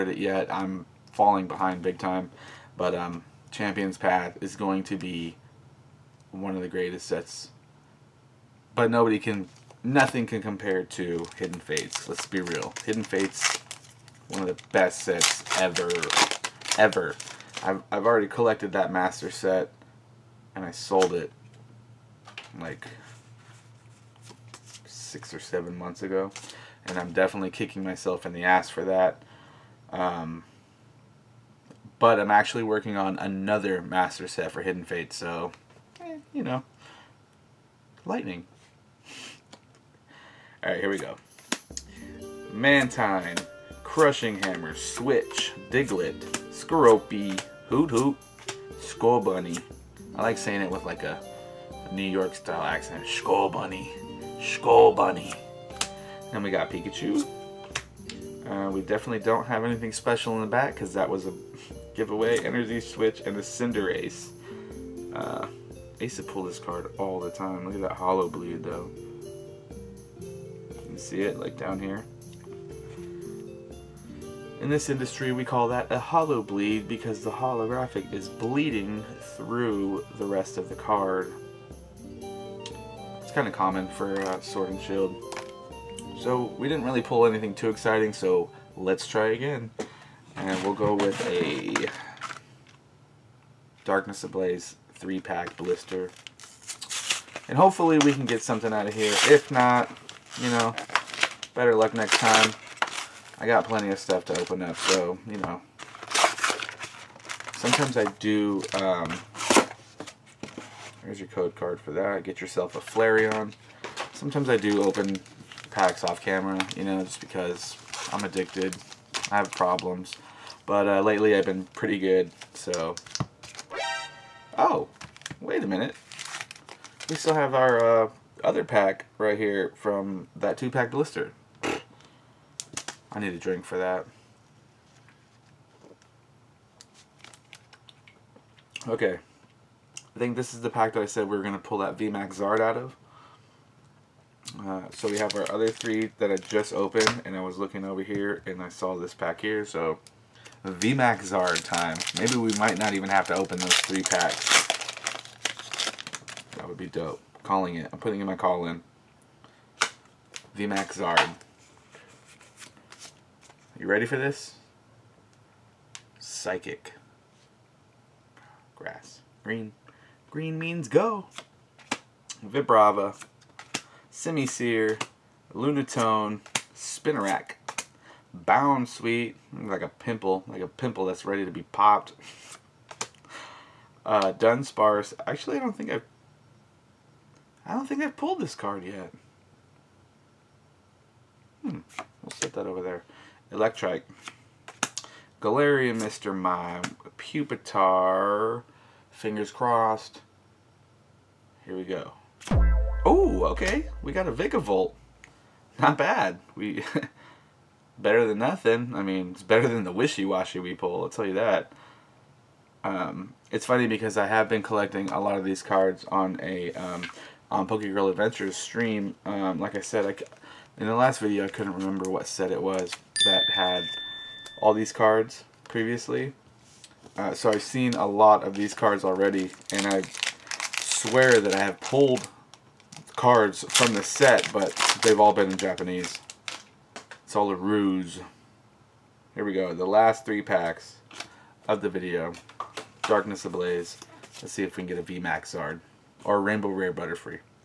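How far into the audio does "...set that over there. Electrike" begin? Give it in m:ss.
3:12.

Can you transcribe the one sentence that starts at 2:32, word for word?
Maybe we might not even have to open those three packs.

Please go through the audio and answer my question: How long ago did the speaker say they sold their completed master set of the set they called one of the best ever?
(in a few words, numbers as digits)
6 or 7 months.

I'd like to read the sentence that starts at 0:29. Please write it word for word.
Um, but I'm actually working on another master set for Hidden Fate, so, eh, you know, lightning.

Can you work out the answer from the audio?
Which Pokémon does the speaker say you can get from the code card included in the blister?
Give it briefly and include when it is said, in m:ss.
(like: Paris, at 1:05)
Flareon, at 1:52.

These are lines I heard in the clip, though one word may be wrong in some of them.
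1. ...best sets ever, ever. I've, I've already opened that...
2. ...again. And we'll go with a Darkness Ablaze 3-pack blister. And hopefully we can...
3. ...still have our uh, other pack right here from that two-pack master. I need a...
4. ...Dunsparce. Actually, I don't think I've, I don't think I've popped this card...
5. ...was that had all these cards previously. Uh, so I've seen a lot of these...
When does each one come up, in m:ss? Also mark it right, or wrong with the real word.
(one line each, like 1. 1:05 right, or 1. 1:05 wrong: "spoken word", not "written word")
1. 0:14 wrong: "collected", not "opened"
2. 1:29 right
3. 2:07 wrong: "blister", not "master"
4. 3:04 wrong: "pulled", not "popped"
5. 3:42 right.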